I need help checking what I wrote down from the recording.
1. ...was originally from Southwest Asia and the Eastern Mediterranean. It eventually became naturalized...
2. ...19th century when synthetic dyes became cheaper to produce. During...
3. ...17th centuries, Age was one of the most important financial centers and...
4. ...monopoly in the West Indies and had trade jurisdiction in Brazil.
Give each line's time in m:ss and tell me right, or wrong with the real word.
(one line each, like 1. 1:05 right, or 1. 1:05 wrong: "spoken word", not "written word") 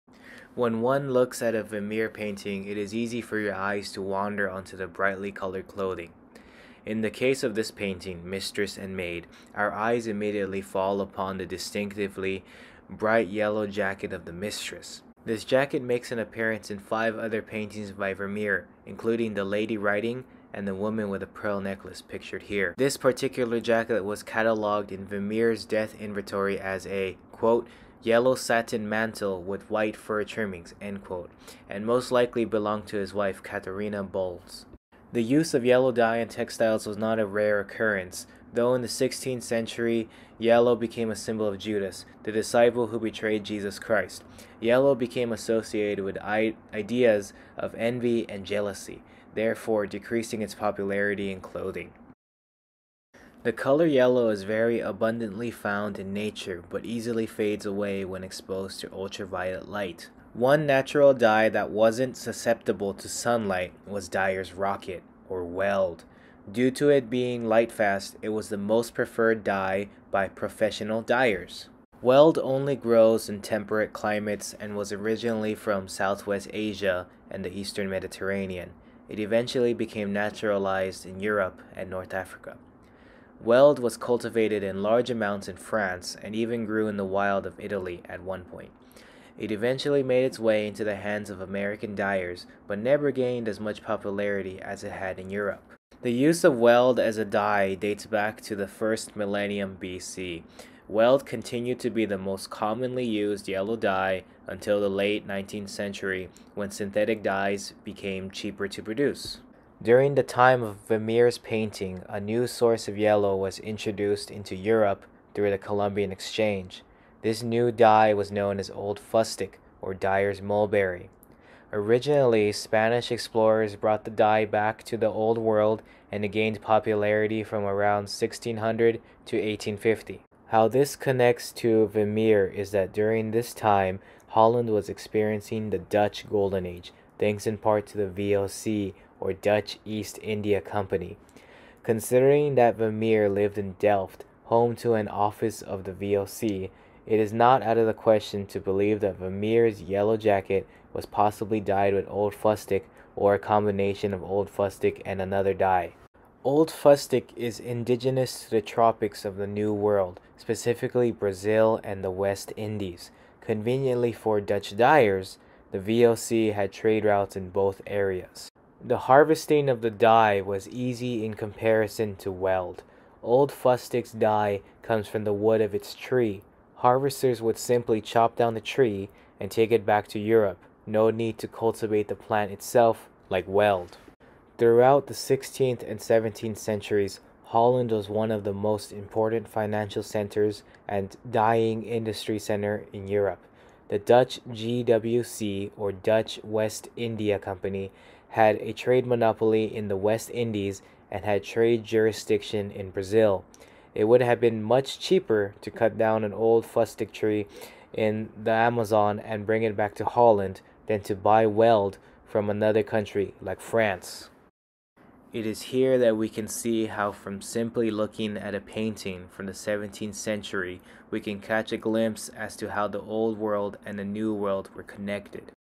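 1. 1:14 right
2. 1:45 right
3. 3:05 wrong: "Holland", not "Age"
4. 3:19 right.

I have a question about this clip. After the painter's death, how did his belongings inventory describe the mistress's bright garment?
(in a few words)
Yellow satin mantle with white fur trimmings.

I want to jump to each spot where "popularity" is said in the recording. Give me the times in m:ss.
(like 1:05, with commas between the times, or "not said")
0:50, 1:33, 2:06.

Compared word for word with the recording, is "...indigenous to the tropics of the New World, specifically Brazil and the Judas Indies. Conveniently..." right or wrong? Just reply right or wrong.
wrong.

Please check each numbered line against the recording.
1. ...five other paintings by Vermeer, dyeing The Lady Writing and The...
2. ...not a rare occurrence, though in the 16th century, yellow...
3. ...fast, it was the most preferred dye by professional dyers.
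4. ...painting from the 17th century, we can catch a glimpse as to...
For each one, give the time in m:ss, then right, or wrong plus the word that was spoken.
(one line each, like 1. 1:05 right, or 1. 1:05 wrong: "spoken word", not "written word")
1. 0:16 wrong: "including", not "dyeing"
2. 0:36 right
3. 1:07 right
4. 3:38 right.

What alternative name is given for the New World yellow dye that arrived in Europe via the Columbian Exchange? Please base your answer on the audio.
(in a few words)
Dyer's Mulberry.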